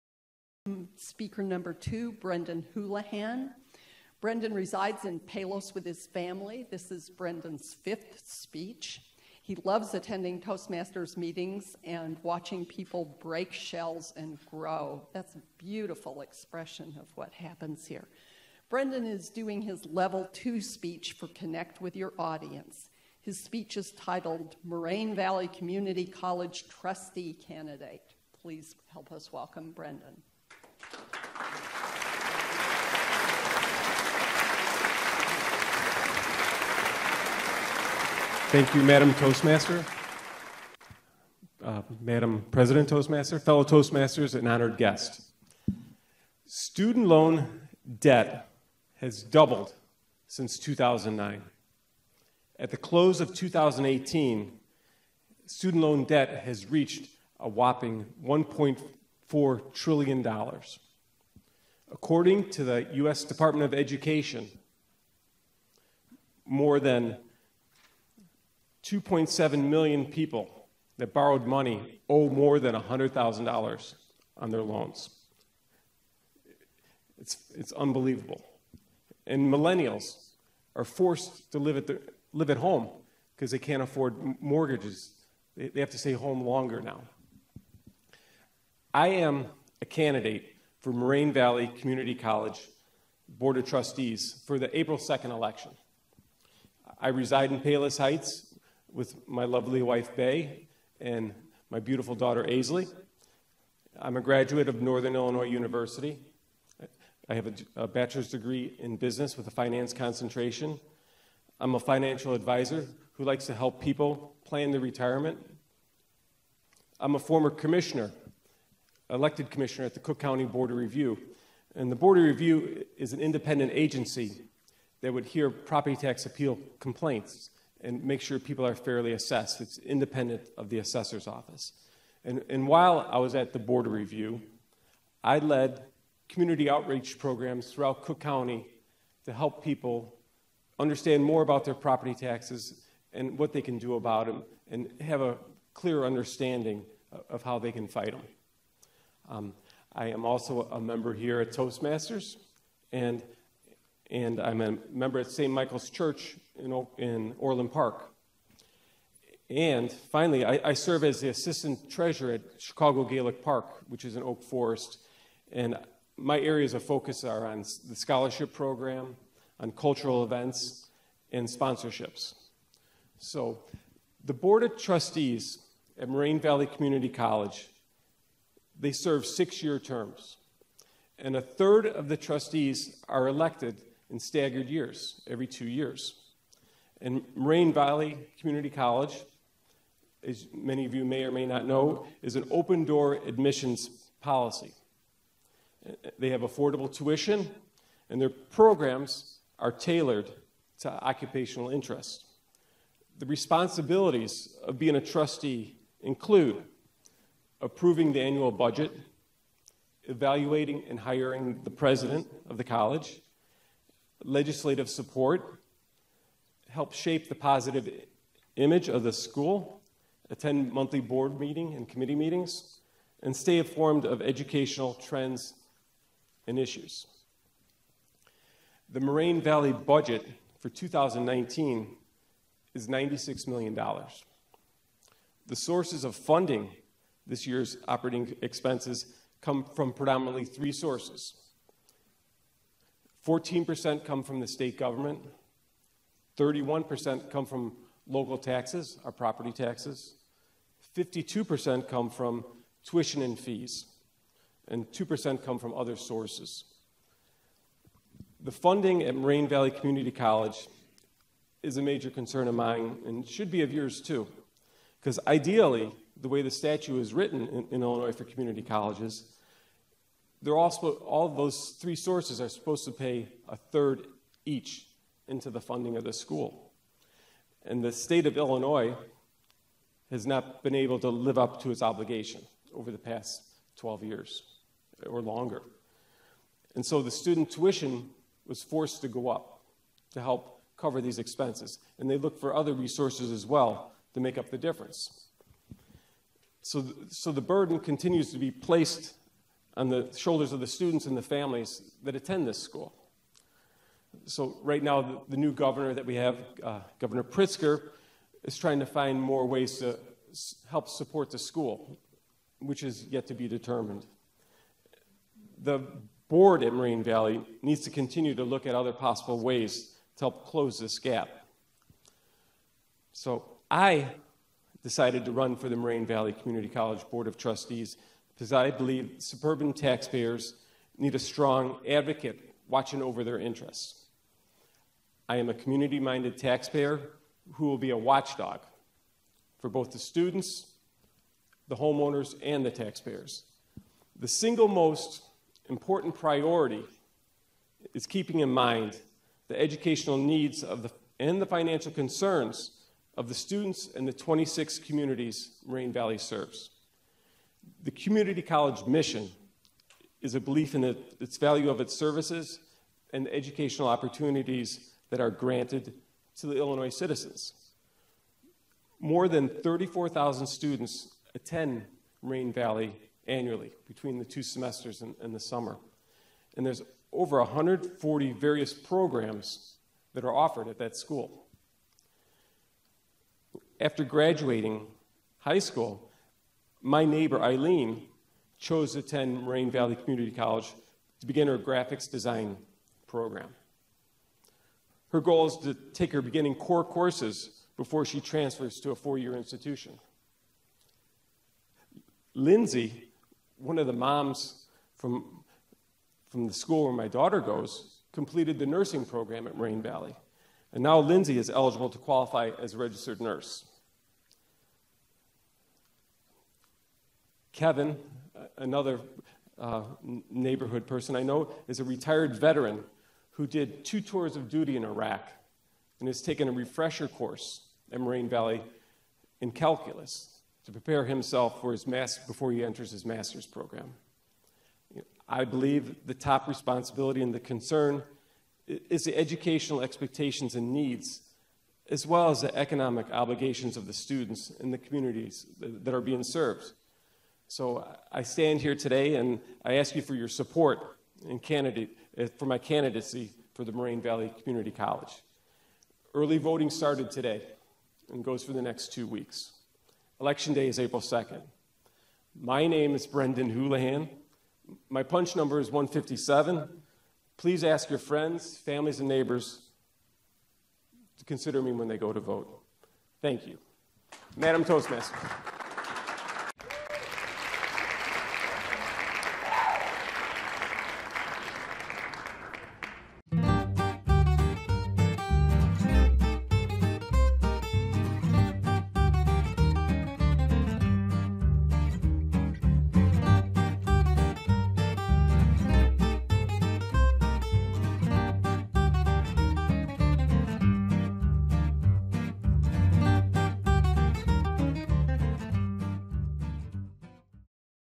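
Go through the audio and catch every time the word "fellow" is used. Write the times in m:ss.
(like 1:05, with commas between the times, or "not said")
0:43.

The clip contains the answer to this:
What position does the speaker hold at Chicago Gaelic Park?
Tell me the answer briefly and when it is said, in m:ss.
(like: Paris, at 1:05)
assistant treasurer, at 2:41.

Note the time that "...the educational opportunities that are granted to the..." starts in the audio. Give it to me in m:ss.
6:03.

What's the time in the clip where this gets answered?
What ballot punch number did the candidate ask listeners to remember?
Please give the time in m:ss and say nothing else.
7:45.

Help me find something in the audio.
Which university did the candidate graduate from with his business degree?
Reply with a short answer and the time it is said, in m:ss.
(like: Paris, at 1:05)
Northern Illinois University, at 1:44.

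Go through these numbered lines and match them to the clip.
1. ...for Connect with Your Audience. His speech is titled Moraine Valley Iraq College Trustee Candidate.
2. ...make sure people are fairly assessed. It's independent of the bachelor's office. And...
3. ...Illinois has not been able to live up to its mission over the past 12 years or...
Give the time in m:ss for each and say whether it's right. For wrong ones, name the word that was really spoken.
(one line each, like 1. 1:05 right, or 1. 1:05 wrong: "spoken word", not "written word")
1. 0:21 wrong: "Community", not "Iraq"
2. 2:08 wrong: "assessor", not "bachelor"
3. 4:38 wrong: "obligation", not "mission".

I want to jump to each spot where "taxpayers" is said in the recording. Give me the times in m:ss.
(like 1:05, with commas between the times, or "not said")
5:29, 5:36, 5:42.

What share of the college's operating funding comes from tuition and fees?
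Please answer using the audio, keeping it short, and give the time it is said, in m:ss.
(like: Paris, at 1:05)
52%, at 4:10.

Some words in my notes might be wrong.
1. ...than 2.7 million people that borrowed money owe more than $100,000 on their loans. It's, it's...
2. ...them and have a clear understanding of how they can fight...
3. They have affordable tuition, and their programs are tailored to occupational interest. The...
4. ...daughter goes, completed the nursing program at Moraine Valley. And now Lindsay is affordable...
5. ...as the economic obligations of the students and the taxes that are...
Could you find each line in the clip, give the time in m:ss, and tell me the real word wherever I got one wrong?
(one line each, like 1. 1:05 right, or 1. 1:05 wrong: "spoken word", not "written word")
1. 1:06 right
2. 2:24 right
3. 3:16 right
4. 6:47 wrong: "eligible", not "affordable"
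5. 7:22 wrong: "communities", not "taxes".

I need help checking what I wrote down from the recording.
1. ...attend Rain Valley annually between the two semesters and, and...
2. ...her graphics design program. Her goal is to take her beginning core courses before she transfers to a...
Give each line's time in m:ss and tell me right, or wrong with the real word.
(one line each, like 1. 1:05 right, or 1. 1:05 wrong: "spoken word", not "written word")
1. 6:11 right
2. 6:31 right.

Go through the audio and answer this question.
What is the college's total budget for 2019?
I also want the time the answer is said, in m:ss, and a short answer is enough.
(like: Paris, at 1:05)
$96 million, at 3:52.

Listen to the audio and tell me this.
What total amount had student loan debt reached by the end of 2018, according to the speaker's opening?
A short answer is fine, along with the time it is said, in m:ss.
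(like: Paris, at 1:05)
$1.4 trillion, at 0:58.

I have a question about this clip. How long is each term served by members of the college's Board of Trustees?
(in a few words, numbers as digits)
6 years.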